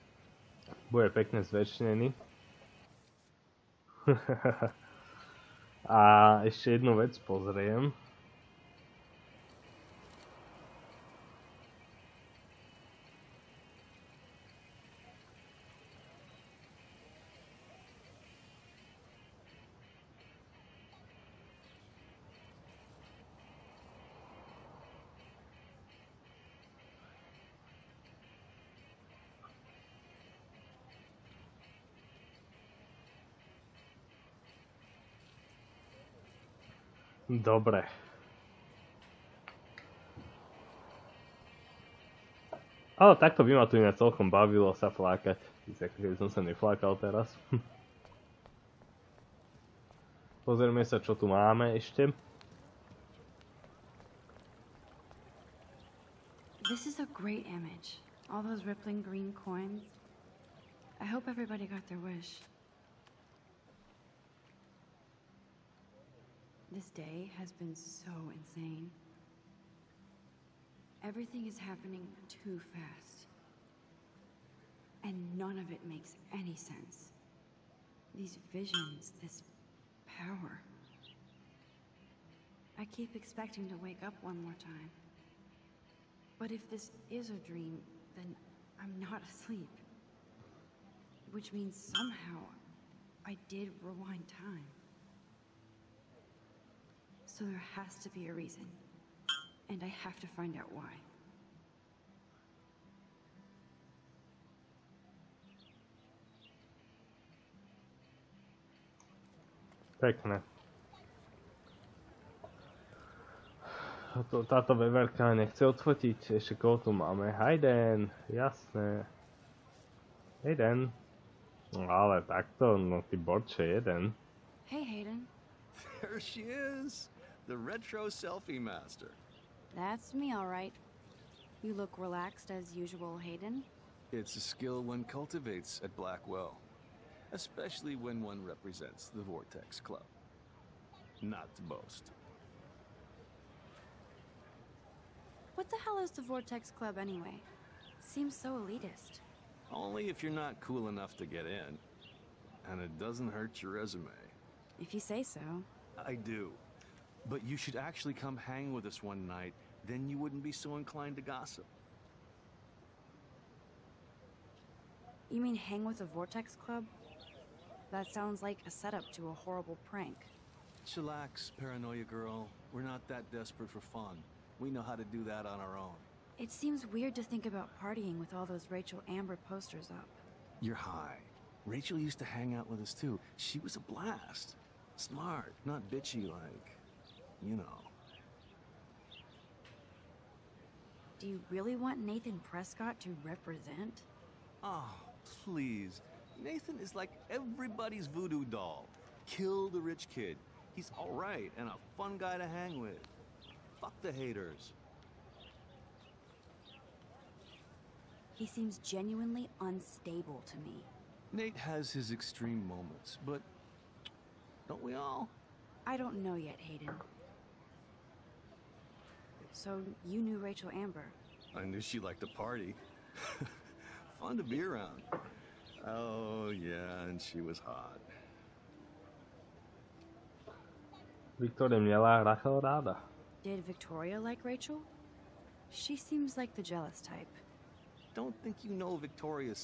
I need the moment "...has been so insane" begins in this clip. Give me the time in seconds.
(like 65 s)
67 s.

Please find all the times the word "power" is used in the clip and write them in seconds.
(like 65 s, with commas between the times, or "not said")
80 s.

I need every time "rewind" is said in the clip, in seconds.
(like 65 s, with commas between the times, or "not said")
93 s.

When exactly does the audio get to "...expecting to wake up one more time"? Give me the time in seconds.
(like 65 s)
83 s.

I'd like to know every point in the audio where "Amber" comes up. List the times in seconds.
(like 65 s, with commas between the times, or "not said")
179 s, 220 s.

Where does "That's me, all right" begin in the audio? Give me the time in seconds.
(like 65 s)
129 s.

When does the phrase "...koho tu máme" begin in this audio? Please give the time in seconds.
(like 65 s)
116 s.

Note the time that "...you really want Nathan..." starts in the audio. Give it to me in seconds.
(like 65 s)
191 s.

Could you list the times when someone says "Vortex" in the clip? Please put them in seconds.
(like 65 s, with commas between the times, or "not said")
139 s, 146 s, 166 s.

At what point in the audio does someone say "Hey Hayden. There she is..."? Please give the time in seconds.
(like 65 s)
124 s.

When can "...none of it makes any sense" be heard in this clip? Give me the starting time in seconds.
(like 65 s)
75 s.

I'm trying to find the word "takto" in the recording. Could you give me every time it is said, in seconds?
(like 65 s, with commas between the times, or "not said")
43 s, 122 s.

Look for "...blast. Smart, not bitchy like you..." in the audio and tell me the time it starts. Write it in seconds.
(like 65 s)
183 s.